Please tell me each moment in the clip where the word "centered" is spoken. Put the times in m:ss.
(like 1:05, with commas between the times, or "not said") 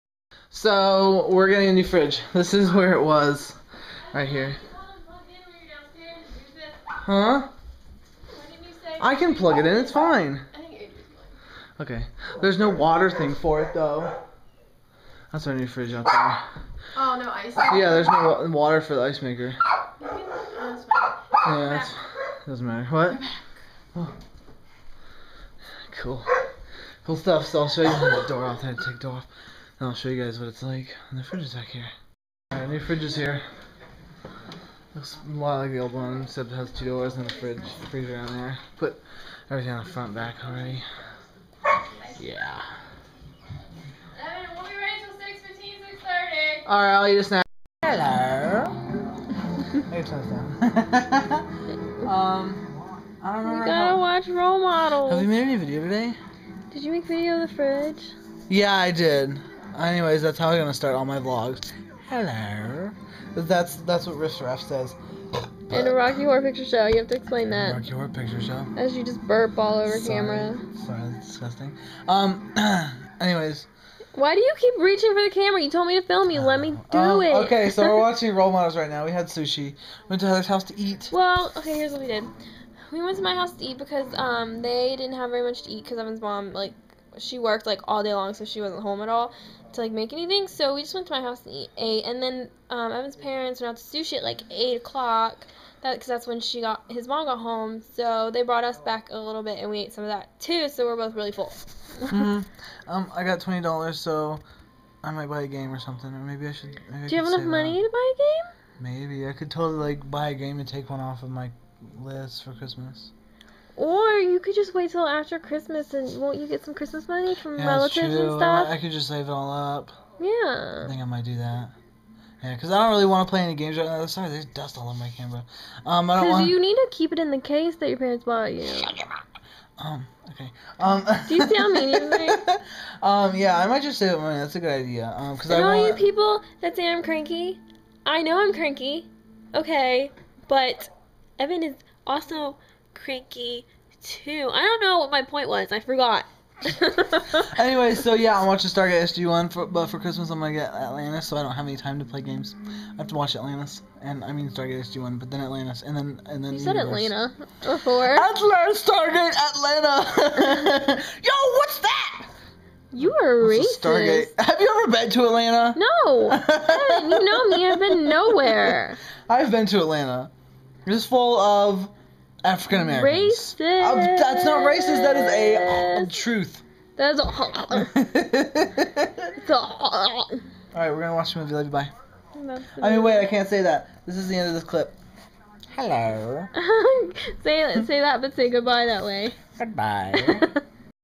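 not said.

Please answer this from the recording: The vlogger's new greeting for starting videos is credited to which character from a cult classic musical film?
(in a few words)
Riff Raff.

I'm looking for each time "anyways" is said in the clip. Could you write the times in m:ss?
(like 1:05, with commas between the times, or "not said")
0:59, 1:13, 2:27.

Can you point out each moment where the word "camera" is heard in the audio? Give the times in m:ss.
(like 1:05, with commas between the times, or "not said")
1:10, 1:15, 2:05.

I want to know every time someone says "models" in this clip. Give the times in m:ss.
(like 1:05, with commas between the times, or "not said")
0:54, 1:18.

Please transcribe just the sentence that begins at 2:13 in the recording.
Yeah, I might just save money.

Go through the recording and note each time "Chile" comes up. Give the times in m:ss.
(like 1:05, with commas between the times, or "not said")
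not said.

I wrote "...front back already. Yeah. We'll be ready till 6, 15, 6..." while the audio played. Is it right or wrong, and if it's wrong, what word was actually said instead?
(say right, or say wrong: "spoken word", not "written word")
right.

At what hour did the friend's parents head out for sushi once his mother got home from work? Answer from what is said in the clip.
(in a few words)
8 o'clock.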